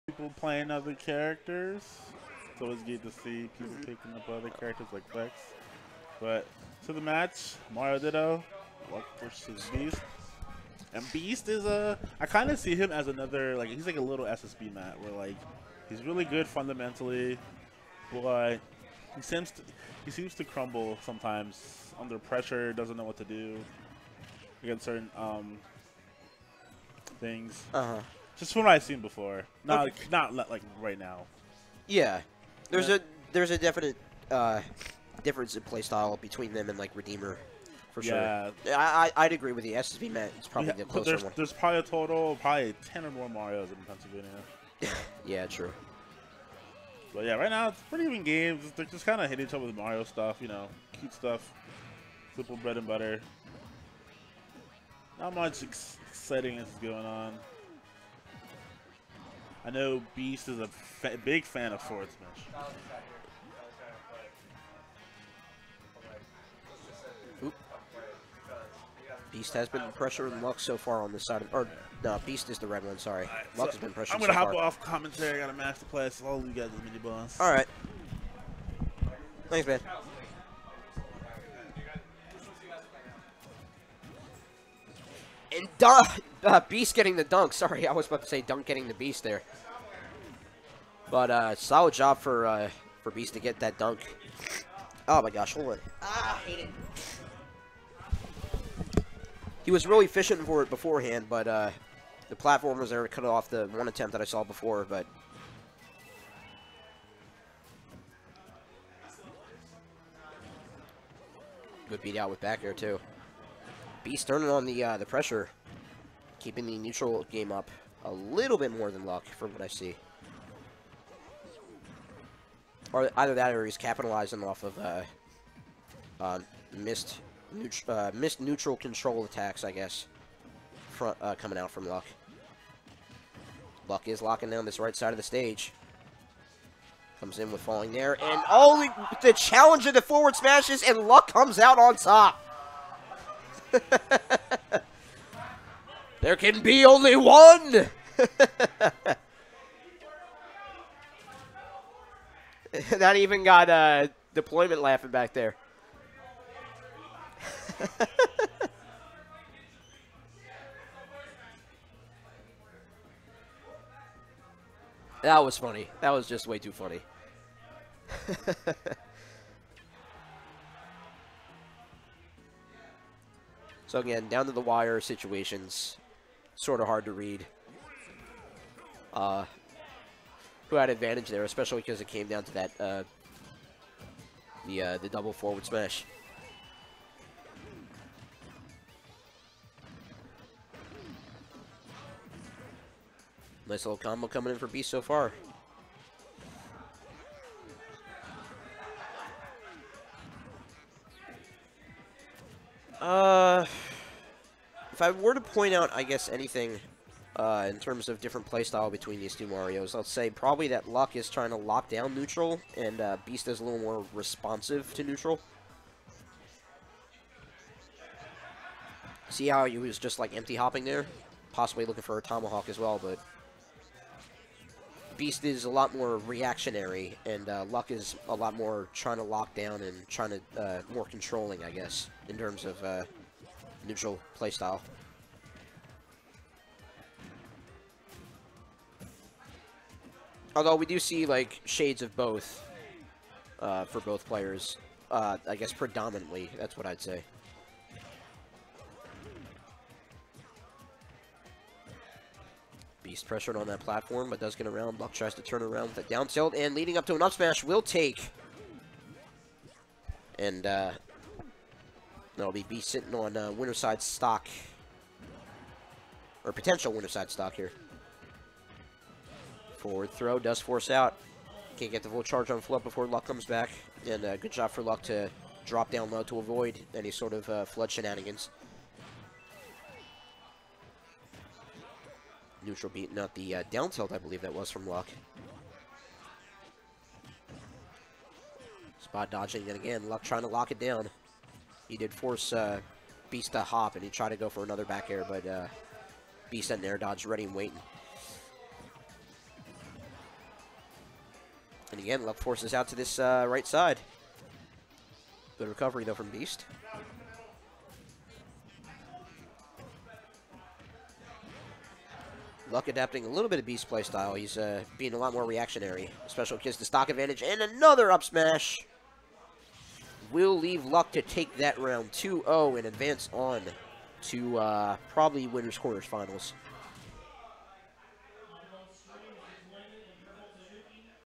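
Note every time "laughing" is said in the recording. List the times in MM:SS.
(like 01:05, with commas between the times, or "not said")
02:34.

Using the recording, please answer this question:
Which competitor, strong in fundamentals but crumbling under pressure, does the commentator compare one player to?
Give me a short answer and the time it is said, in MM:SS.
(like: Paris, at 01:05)
SSB Met, at 00:14.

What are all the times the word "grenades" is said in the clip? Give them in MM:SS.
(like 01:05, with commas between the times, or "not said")
not said.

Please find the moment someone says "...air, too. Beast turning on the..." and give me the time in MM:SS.
01:52.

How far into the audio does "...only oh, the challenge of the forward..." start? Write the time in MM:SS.
02:18.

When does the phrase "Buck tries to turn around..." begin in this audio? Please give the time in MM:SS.
04:14.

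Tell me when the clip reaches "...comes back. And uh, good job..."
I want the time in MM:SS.
04:33.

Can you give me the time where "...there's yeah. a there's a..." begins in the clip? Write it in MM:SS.
00:32.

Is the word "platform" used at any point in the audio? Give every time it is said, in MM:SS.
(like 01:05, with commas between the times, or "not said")
01:42, 04:13.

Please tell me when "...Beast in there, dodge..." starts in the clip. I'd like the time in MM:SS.
04:56.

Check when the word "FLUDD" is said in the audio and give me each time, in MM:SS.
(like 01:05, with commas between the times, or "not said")
04:32, 04:37.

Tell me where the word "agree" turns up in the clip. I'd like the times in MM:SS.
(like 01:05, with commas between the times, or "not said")
00:39.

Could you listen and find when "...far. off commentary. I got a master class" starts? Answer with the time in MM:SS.
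01:14.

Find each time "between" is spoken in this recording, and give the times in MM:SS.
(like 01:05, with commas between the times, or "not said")
00:36, 03:28.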